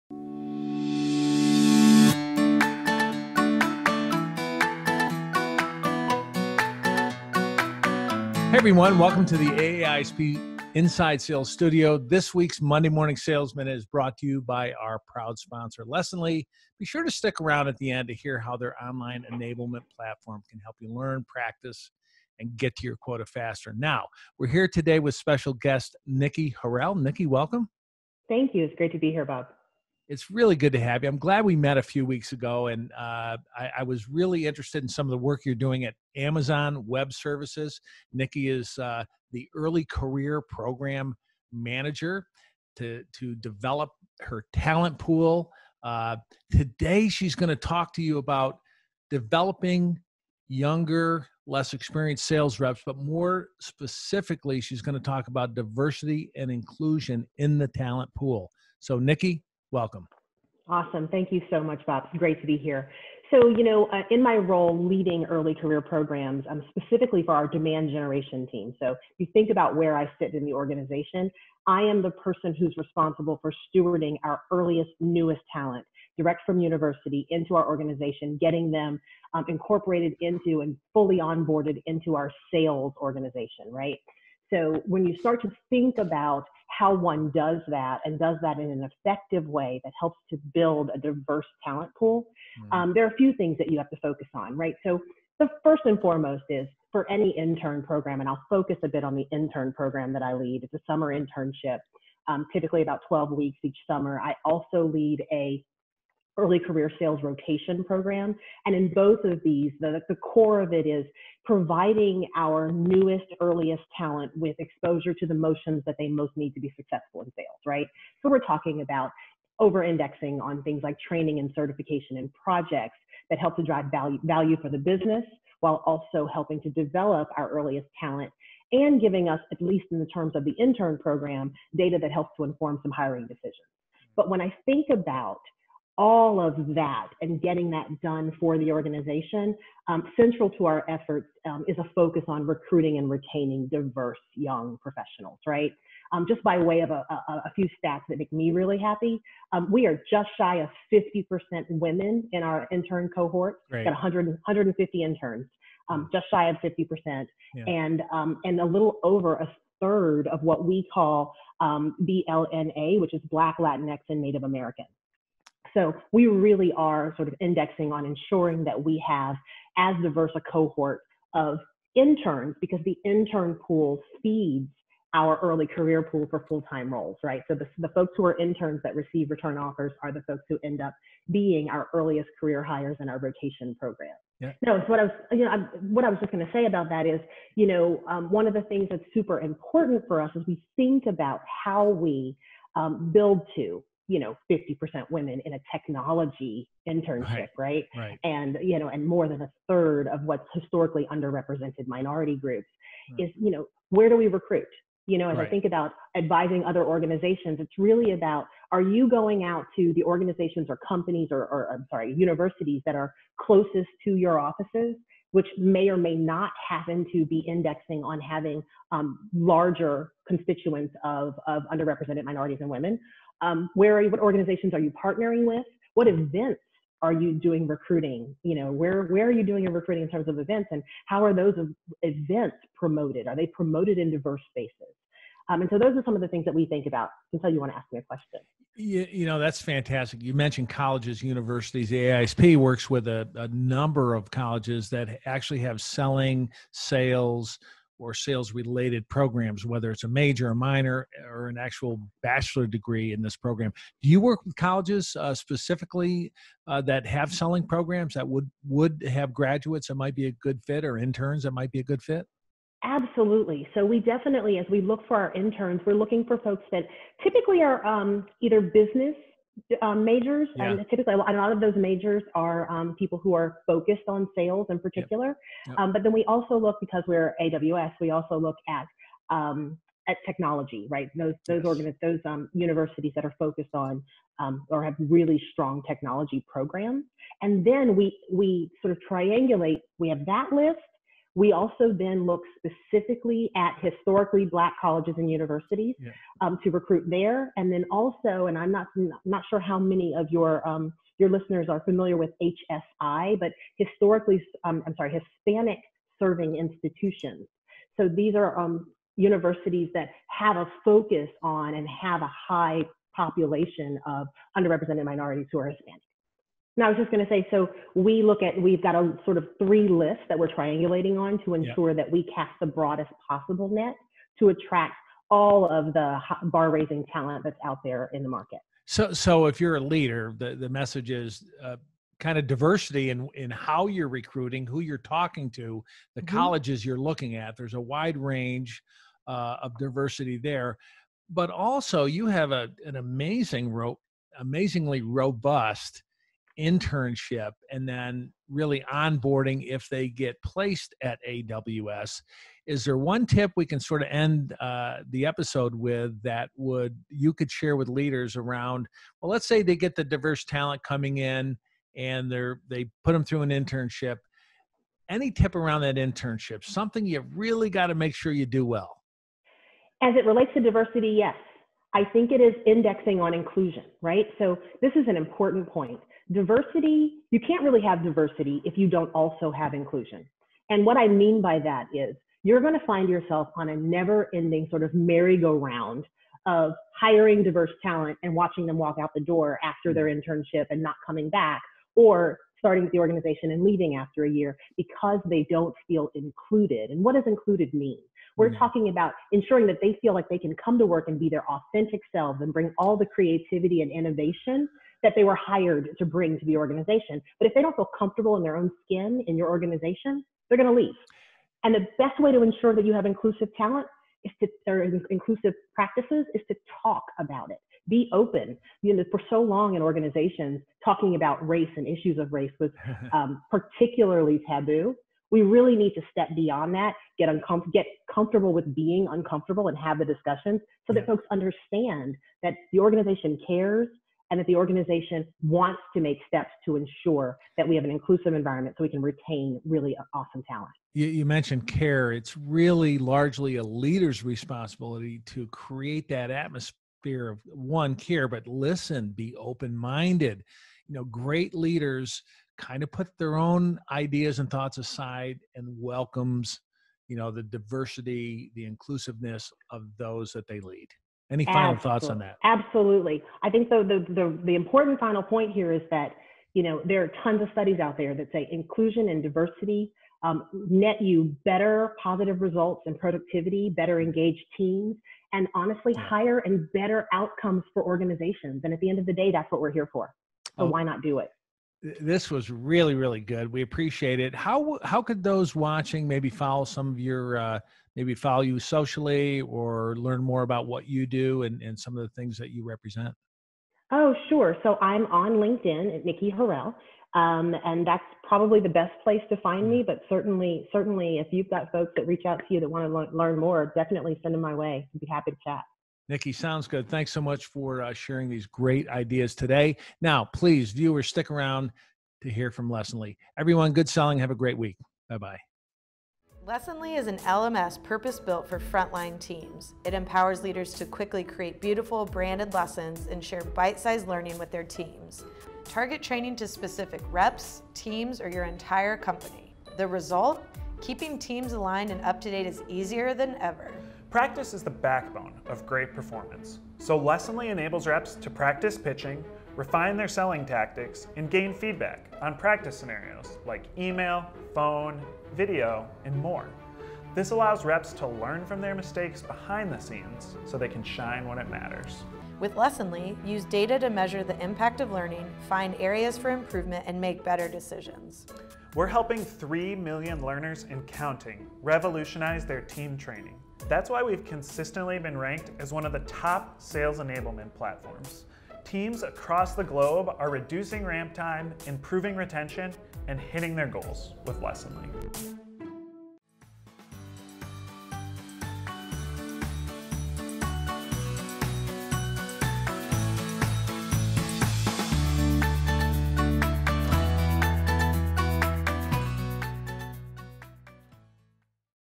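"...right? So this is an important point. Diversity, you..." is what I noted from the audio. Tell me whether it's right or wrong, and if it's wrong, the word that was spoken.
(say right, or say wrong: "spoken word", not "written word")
right.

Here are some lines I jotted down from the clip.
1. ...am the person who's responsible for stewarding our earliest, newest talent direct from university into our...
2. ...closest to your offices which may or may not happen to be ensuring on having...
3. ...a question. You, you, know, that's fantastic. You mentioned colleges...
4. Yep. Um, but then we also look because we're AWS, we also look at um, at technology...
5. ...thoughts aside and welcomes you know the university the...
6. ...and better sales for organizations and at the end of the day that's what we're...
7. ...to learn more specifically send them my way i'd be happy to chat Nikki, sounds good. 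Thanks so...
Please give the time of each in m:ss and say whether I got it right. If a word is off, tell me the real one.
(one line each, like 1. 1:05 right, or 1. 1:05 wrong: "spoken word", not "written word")
1. 1:11 right
2. 3:33 wrong: "indexing", not "ensuring"
3. 3:57 right
4. 4:35 right
5. 7:34 wrong: "diversity", not "university"
6. 7:56 wrong: "outcomes", not "sales"
7. 8:22 wrong: "definitely", not "specifically".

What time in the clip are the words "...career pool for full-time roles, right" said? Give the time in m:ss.
2:55.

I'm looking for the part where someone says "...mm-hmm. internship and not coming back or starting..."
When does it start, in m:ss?
6:30.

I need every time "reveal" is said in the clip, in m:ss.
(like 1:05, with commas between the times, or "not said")
not said.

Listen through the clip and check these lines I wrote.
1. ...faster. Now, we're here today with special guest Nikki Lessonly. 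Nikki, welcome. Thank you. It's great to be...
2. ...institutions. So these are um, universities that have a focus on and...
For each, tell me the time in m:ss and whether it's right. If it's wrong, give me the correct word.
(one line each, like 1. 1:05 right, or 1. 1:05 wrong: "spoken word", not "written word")
1. 0:23 wrong: "Harrell", not "Lessonly"
2. 5:06 right.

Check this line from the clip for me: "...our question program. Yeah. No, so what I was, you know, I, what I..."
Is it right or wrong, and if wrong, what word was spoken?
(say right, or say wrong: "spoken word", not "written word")
wrong: "rotation", not "question".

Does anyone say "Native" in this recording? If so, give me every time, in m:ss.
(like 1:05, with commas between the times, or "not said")
2:44.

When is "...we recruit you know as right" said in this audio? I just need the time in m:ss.
3:24.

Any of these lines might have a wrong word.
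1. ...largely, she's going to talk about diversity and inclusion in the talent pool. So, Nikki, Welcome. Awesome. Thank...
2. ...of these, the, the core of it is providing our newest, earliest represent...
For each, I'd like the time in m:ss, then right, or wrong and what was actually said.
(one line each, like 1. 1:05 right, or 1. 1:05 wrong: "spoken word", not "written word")
1. 0:53 wrong: "specifically", not "largely"
2. 1:49 wrong: "talent", not "represent".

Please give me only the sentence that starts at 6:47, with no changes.
But if they don't feel comfortable in their own skin in your organization, they're going to leave.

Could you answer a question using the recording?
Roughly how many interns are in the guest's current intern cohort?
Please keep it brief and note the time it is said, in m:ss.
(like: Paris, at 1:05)
150, at 2:34.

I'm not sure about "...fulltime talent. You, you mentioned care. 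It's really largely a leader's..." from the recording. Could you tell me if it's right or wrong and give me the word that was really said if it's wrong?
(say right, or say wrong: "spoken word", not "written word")
wrong: "awesome", not "fulltime".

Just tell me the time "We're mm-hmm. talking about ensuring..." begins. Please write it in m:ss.
6:38.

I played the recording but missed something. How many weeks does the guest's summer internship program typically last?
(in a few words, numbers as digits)
12.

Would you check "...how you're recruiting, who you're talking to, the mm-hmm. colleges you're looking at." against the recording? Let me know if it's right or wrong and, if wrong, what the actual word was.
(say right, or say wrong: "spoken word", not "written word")
right.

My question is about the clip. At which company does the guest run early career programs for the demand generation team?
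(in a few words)
Amazon Web Services.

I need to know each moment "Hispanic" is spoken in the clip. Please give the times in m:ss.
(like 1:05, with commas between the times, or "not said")
5:05, 5:15.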